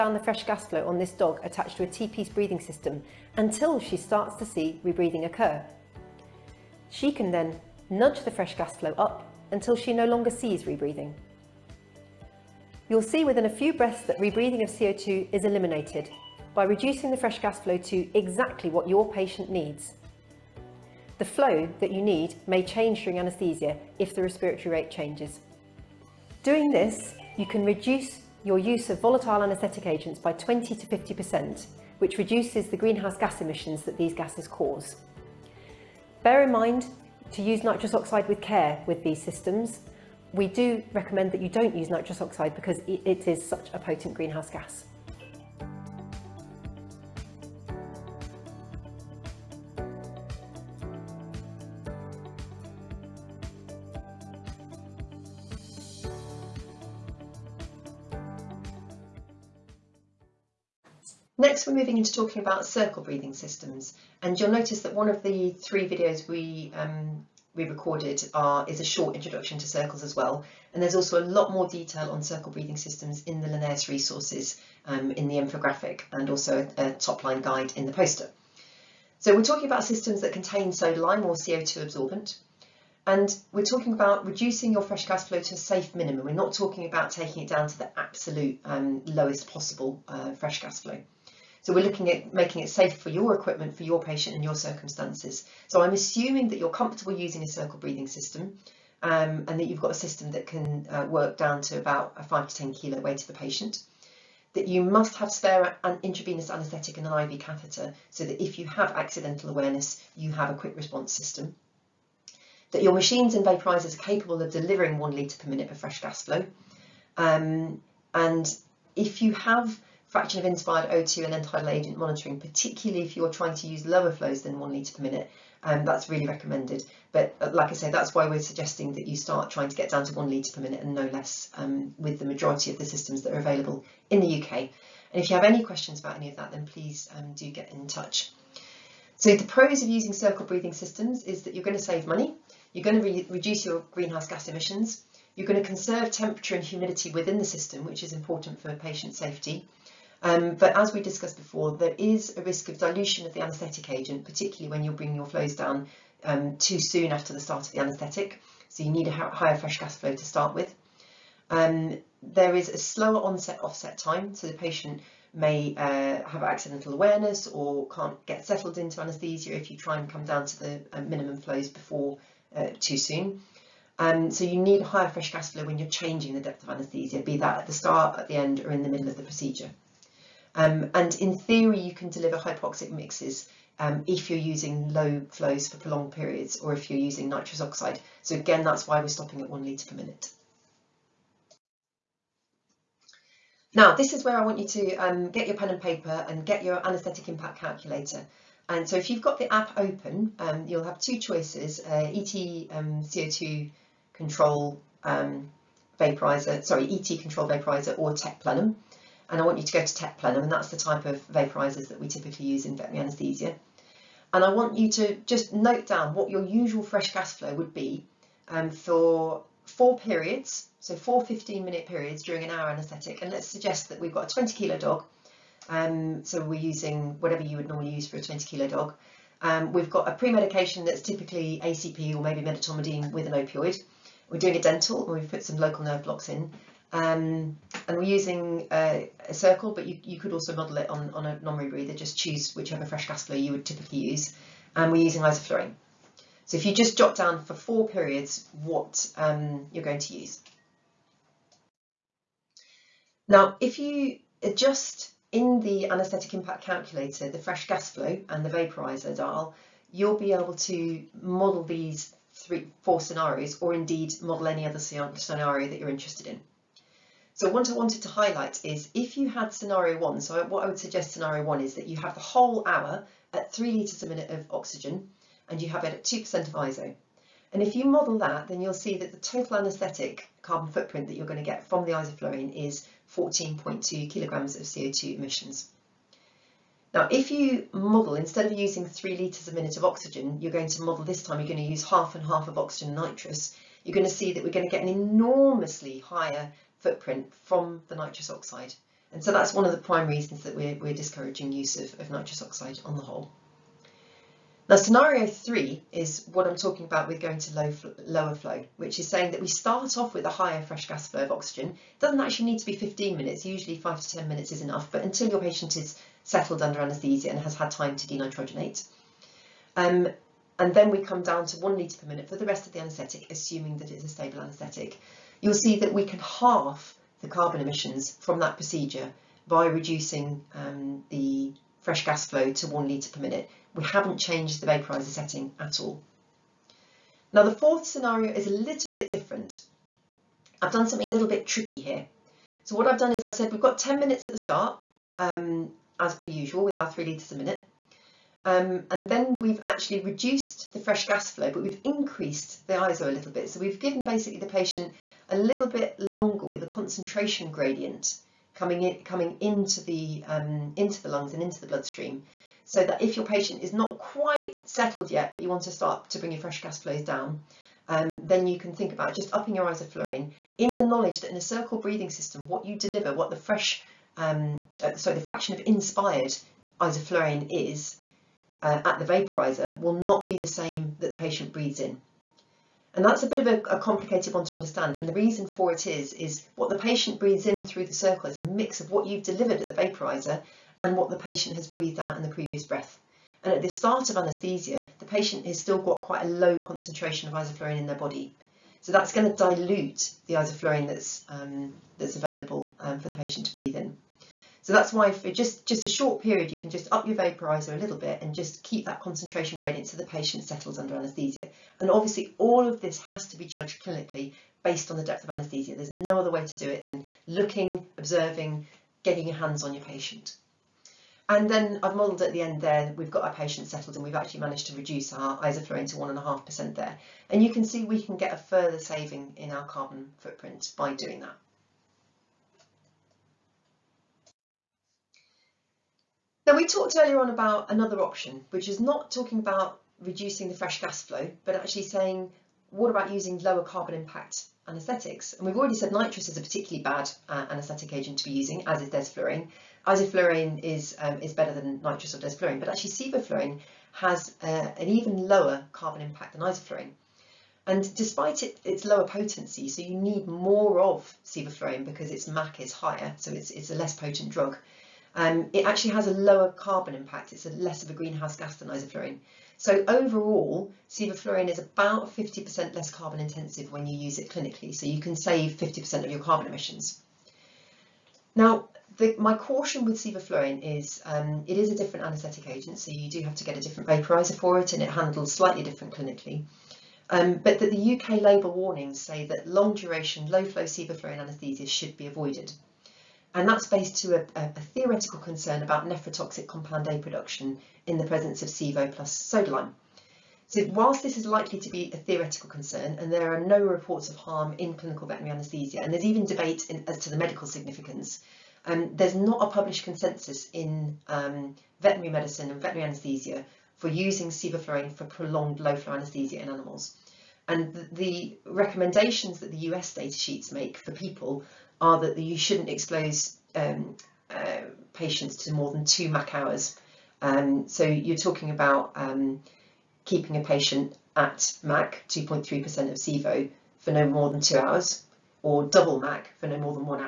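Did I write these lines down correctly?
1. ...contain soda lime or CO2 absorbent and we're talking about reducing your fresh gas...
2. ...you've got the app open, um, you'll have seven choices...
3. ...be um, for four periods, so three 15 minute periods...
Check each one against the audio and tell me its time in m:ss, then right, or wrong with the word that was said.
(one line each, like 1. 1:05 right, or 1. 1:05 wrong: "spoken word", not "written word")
1. 1:20 right
2. 3:19 wrong: "two", not "seven"
3. 3:37 wrong: "four", not "three".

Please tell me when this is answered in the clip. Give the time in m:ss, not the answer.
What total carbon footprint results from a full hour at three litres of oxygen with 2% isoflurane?
4:43.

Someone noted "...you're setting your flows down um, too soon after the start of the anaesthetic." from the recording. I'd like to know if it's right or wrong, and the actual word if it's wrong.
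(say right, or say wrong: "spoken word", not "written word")
wrong: "bringing", not "setting".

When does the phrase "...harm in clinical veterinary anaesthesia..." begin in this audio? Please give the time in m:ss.
8:24.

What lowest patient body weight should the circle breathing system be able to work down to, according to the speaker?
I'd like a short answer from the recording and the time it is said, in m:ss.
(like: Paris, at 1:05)
5 to 10 kilos, at 1:42.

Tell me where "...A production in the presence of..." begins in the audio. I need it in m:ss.
8:16.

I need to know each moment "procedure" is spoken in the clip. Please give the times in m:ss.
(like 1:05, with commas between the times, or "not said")
2:59, 5:28.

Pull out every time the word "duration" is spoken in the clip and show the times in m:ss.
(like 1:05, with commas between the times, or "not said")
8:09.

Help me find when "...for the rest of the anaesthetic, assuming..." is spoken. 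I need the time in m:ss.
5:22.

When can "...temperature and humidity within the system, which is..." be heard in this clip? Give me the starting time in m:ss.
2:26.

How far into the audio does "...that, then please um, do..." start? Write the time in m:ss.
2:16.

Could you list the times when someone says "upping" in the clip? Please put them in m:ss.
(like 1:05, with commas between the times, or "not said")
6:09.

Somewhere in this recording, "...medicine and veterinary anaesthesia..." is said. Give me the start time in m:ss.
8:32.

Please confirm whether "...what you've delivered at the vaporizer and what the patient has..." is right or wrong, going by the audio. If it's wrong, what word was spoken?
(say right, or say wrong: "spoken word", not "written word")
right.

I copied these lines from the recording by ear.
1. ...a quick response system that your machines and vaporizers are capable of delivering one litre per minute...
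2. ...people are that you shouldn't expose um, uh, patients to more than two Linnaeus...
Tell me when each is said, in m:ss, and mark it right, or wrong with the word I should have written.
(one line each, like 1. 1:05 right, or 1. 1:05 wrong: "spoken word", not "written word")
1. 1:50 right
2. 8:40 wrong: "MAC", not "Linnaeus".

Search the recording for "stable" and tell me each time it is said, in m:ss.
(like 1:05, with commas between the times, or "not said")
5:24.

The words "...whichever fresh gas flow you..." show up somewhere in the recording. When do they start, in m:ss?
4:02.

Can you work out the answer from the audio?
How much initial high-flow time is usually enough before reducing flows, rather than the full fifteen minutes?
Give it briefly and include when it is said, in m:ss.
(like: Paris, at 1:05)
5 to 10 minutes, at 5:13.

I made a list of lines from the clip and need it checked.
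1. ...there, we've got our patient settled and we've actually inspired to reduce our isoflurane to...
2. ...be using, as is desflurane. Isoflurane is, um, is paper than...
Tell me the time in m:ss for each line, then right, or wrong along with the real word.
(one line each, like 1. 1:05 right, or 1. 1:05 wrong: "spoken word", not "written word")
1. 7:02 wrong: "managed", not "inspired"
2. 7:28 wrong: "better", not "paper".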